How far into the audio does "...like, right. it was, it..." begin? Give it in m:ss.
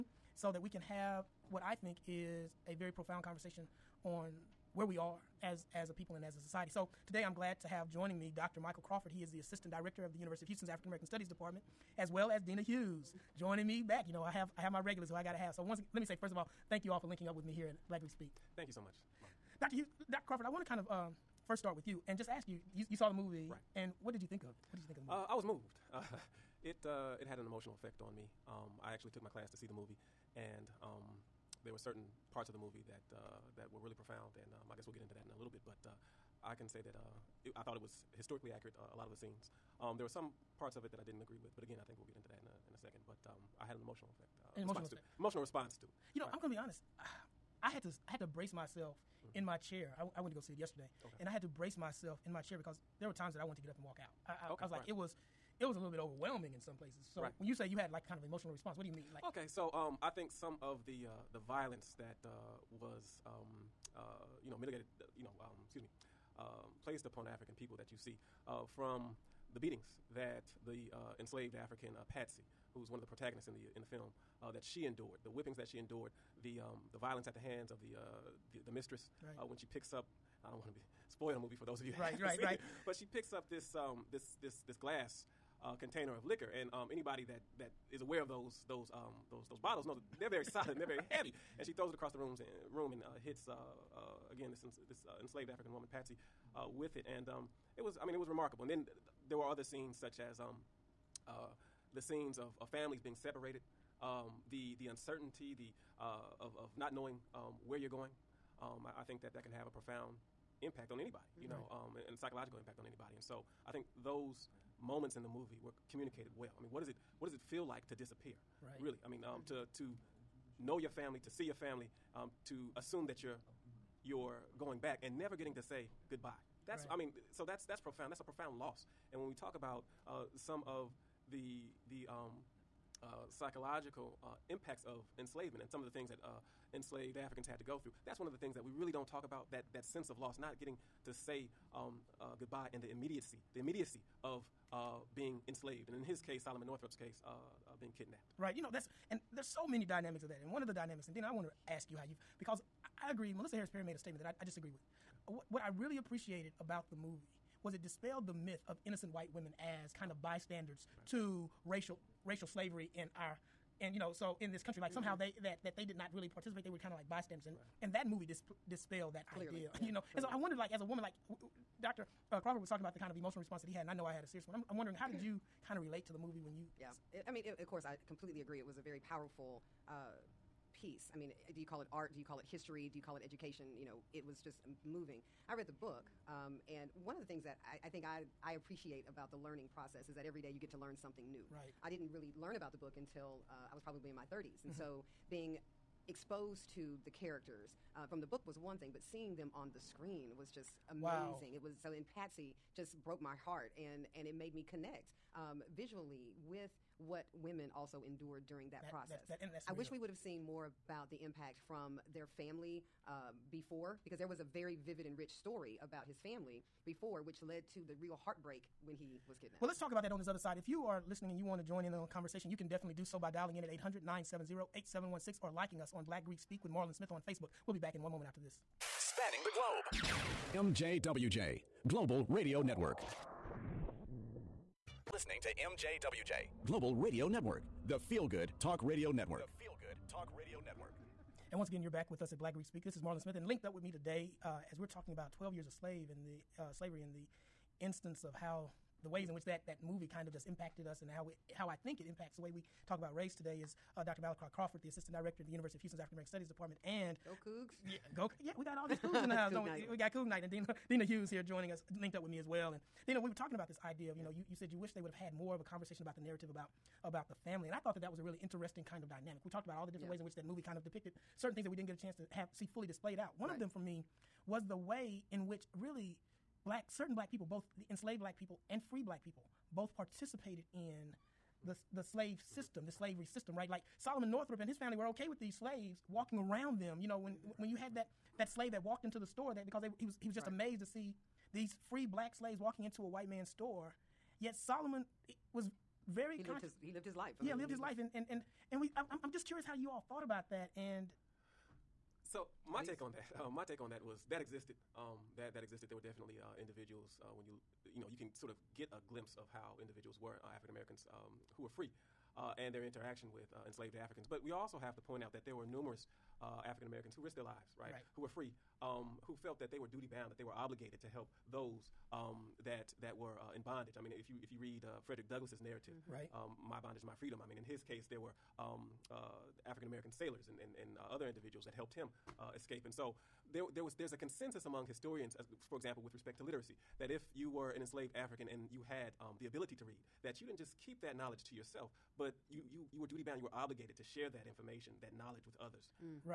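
0:54.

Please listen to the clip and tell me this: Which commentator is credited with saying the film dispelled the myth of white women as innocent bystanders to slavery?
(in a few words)
Melissa Harris Perry.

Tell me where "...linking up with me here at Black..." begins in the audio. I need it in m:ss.
0:17.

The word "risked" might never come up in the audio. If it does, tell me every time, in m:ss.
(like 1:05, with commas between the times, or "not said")
5:17.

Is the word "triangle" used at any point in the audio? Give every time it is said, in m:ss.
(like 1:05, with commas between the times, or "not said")
not said.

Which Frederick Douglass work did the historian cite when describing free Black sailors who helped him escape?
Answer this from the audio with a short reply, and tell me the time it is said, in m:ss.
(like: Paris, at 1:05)
My Bondage, My Freedom, at 5:26.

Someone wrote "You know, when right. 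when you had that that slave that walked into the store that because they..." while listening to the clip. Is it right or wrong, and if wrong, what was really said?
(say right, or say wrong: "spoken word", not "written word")
right.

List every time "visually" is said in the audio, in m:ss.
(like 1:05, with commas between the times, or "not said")
3:25.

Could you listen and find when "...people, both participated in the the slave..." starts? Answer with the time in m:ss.
4:39.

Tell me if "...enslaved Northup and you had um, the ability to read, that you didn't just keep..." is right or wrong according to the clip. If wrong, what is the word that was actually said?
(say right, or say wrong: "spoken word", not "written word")
wrong: "African", not "Northup".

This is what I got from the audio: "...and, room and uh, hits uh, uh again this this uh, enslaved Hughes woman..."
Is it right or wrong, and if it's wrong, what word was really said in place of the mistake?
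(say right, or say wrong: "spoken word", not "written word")
wrong: "African", not "Hughes".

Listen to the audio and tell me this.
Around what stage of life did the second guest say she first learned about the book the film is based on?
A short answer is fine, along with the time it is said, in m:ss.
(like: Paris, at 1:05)
Her 30s, at 3:14.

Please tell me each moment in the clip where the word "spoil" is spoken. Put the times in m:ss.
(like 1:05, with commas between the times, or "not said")
1:21.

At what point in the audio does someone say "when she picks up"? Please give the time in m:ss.
1:19.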